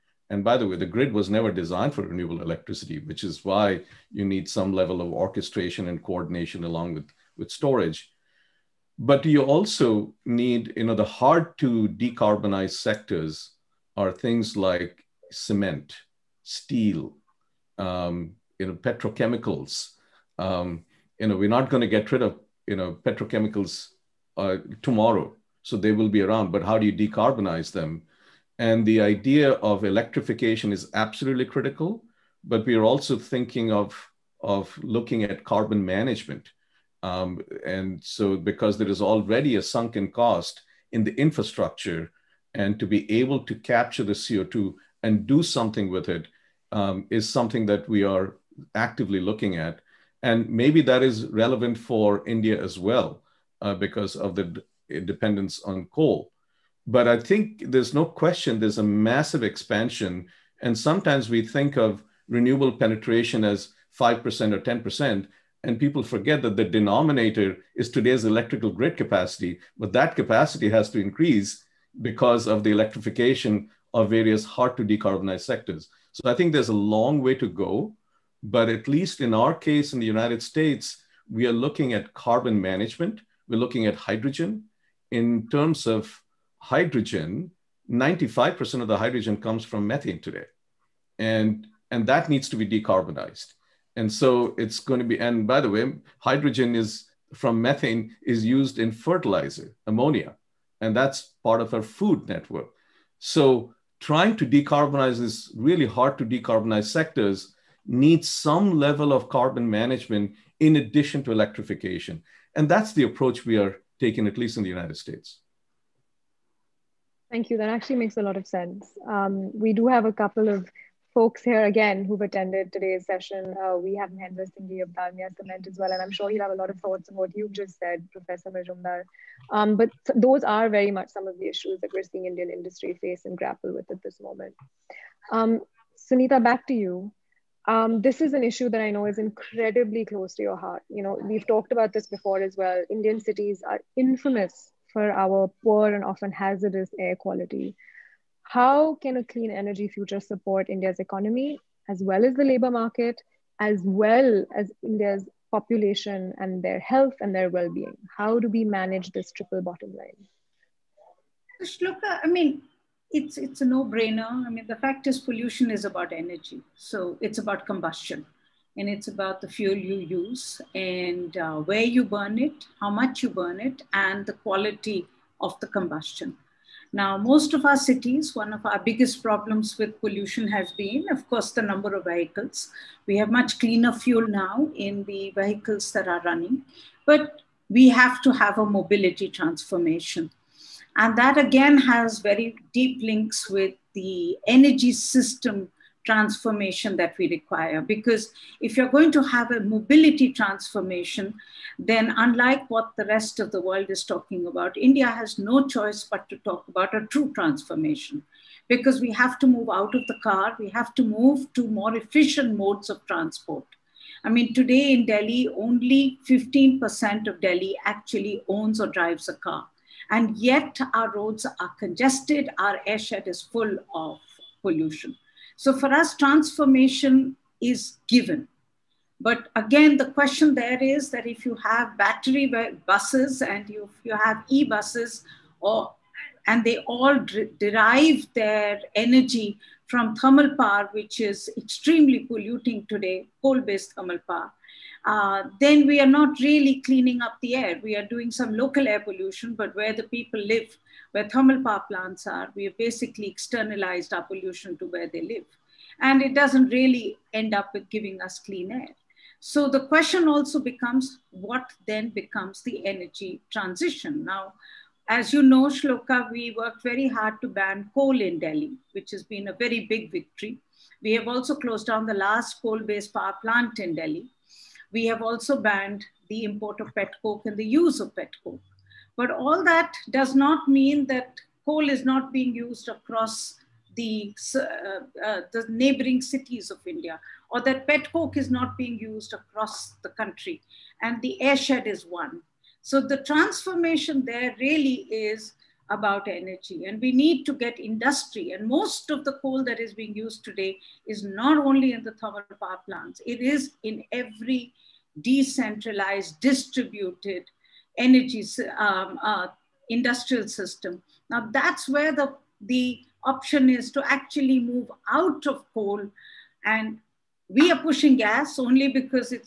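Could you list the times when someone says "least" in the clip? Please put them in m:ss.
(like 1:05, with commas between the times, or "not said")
1:18, 1:54.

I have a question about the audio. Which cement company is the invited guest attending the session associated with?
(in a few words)
Dalmia Cement.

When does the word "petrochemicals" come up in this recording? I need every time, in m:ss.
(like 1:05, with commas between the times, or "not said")
0:18, 0:23.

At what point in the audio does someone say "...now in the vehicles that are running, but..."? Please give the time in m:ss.
3:04.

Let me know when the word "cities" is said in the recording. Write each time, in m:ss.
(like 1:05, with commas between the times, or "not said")
2:23, 2:57, 4:46.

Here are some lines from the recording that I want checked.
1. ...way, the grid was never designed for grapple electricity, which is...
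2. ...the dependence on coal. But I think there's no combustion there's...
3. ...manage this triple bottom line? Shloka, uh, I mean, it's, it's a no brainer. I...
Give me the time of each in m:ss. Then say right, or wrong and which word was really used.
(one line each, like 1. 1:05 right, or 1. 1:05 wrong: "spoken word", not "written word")
1. 0:00 wrong: "renewable", not "grapple"
2. 0:54 wrong: "question", not "combustion"
3. 2:38 right.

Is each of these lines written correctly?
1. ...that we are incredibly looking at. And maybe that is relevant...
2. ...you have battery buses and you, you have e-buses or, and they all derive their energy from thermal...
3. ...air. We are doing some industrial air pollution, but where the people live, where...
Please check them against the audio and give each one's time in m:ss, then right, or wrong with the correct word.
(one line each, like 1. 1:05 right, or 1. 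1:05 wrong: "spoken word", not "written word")
1. 0:47 wrong: "actively", not "incredibly"
2. 3:51 right
3. 4:07 wrong: "local", not "industrial".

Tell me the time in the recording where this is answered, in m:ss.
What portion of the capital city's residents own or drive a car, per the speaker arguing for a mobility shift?
3:36.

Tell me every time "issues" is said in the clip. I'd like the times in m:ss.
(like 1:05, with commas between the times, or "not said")
2:11, 2:18.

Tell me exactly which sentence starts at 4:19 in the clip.
So the question also becomes what then becomes the energy transition?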